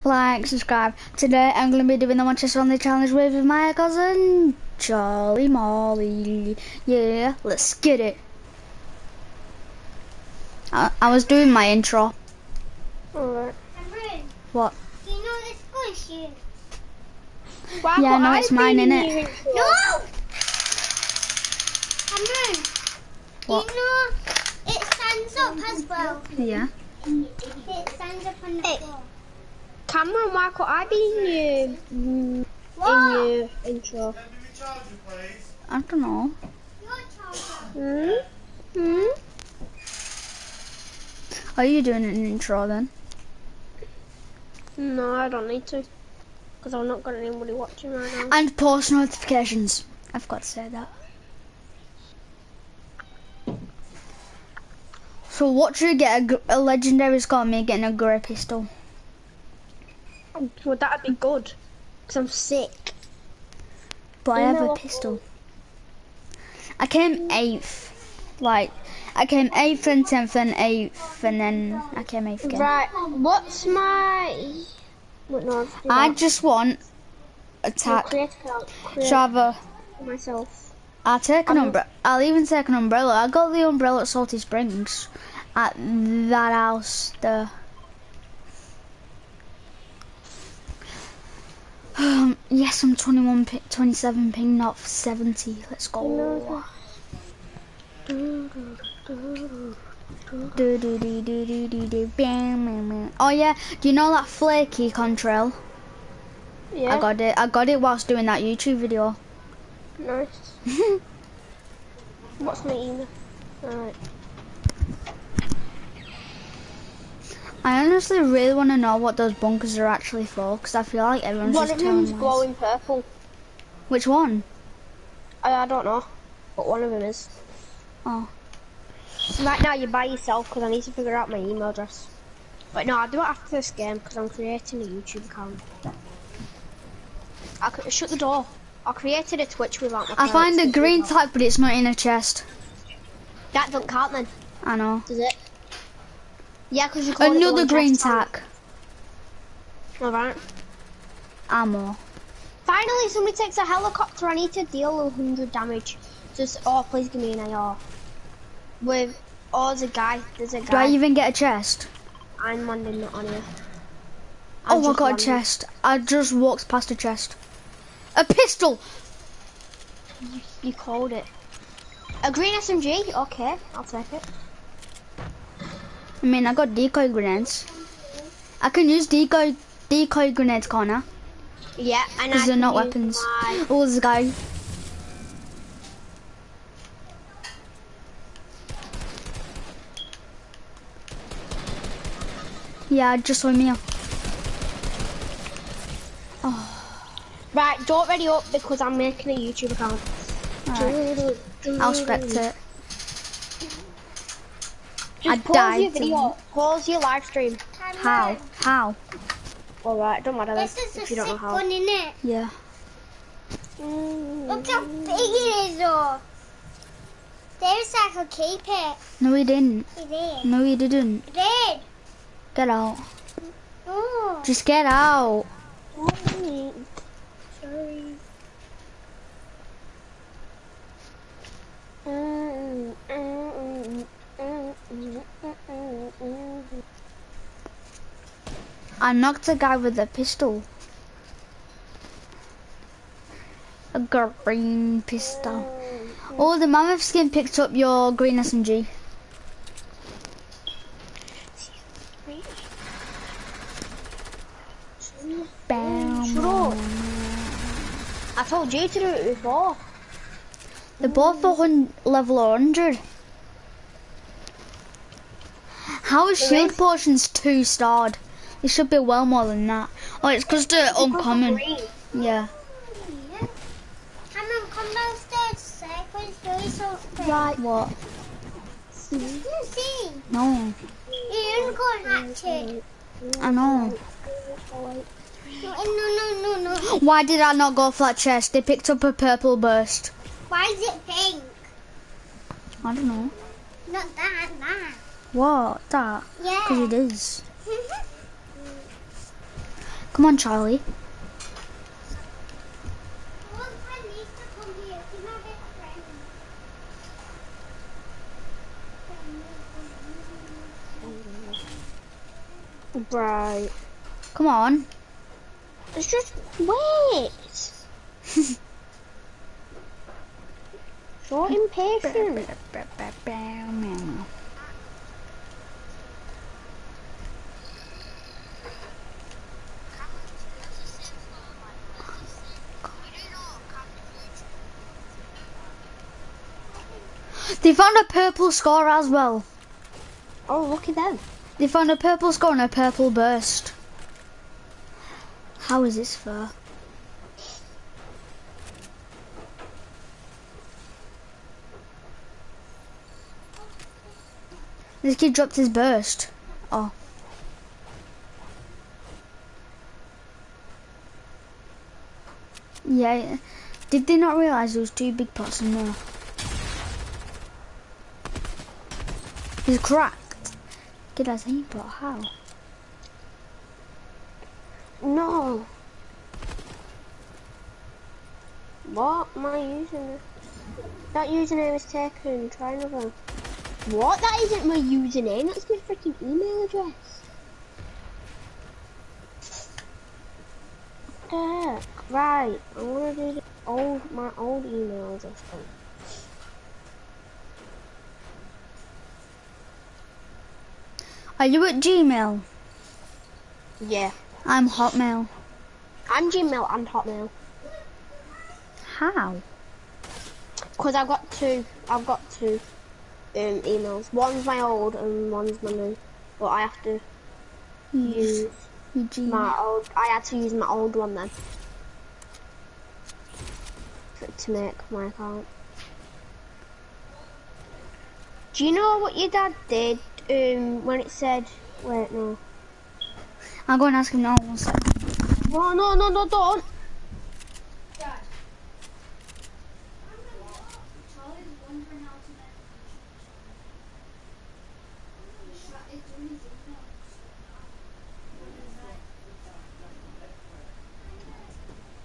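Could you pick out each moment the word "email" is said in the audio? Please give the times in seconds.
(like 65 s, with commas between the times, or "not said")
112 s, 131 s, 386 s, 394 s, 413 s.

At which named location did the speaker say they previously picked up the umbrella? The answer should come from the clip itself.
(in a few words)
Salty Springs.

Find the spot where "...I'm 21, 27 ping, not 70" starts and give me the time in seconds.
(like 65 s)
92 s.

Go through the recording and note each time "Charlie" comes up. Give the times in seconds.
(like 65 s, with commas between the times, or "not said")
4 s, 300 s.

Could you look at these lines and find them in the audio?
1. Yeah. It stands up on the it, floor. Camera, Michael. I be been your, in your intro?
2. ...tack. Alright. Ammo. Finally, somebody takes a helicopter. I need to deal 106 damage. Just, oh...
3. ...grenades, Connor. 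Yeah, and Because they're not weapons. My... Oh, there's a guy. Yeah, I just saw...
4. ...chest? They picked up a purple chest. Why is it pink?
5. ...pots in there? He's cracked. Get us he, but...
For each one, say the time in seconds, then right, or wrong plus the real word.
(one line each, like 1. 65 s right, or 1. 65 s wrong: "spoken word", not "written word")
1. 26 s right
2. 147 s wrong: "100", not "106"
3. 180 s right
4. 288 s wrong: "burst", not "chest"
5. 365 s right.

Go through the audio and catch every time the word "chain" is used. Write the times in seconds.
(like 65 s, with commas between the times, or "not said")
not said.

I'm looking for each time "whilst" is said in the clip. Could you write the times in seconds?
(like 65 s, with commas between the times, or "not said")
107 s.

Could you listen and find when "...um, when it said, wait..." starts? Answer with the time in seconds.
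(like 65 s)
430 s.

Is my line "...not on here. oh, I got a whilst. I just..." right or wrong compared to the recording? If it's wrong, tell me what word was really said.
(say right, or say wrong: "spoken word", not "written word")
wrong: "chest", not "whilst".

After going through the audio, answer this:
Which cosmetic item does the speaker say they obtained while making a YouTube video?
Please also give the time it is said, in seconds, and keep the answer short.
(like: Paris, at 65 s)
Flaky contrail, at 104 s.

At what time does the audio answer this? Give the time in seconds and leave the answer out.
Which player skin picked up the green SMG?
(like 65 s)
246 s.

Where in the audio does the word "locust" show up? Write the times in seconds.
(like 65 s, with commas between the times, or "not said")
not said.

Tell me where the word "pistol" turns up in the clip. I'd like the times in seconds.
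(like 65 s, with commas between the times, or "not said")
58 s, 64 s, 168 s, 240 s, 245 s.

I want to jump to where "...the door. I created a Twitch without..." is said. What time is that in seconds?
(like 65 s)
138 s.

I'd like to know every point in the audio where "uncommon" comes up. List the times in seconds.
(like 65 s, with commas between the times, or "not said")
270 s.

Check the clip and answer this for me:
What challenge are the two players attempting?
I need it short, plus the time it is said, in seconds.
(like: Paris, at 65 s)
One Chest Only Challenge, at 2 s.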